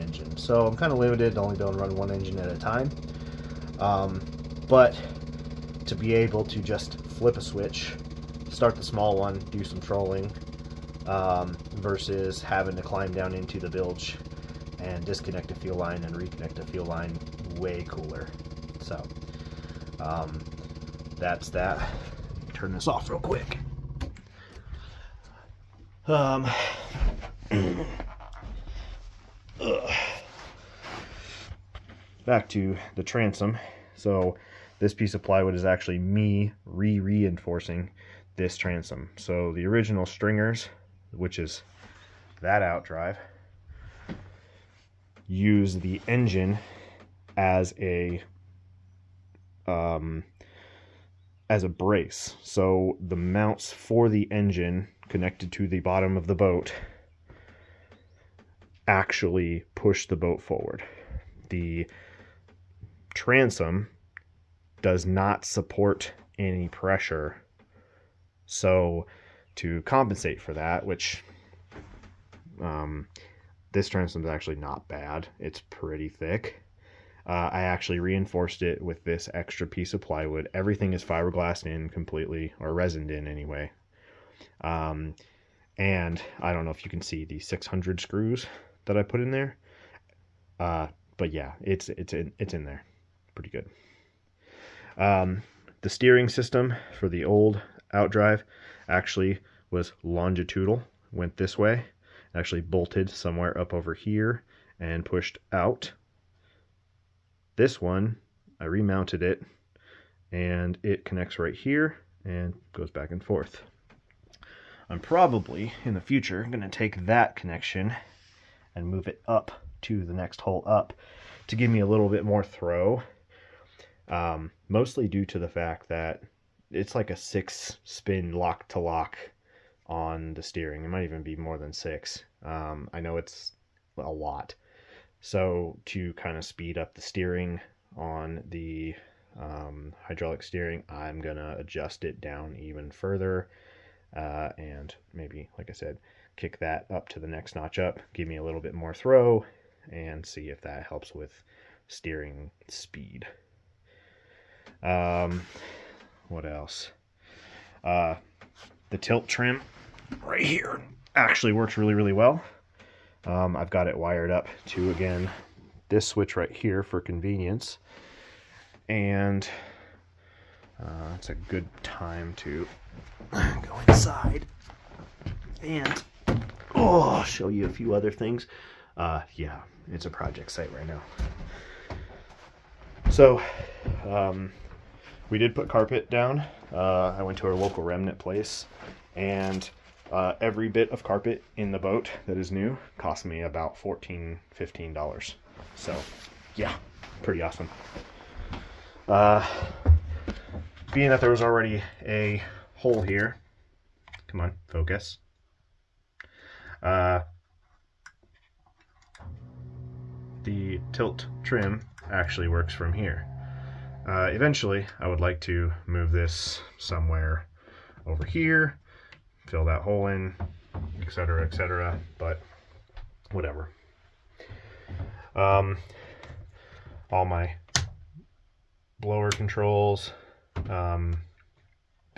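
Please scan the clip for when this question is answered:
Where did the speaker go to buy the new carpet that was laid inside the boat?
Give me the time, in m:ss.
3:07.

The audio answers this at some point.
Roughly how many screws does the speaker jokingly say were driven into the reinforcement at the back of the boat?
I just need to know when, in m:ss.
1:27.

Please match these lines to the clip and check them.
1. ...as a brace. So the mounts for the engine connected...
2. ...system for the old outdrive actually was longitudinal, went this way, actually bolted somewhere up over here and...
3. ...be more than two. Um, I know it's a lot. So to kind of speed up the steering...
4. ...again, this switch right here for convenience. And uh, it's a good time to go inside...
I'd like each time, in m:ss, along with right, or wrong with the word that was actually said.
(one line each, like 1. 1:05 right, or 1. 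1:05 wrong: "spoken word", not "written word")
1. 0:51 right
2. 1:36 right
3. 2:11 wrong: "six", not "two"
4. 2:44 right.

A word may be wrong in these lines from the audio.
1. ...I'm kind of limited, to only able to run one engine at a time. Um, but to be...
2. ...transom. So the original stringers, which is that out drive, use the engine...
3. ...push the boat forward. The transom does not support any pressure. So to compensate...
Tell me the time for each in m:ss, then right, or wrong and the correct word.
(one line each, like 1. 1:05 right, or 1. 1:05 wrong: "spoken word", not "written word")
1. 0:00 right
2. 0:38 right
3. 0:59 right.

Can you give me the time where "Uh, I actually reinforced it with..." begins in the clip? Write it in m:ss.
1:17.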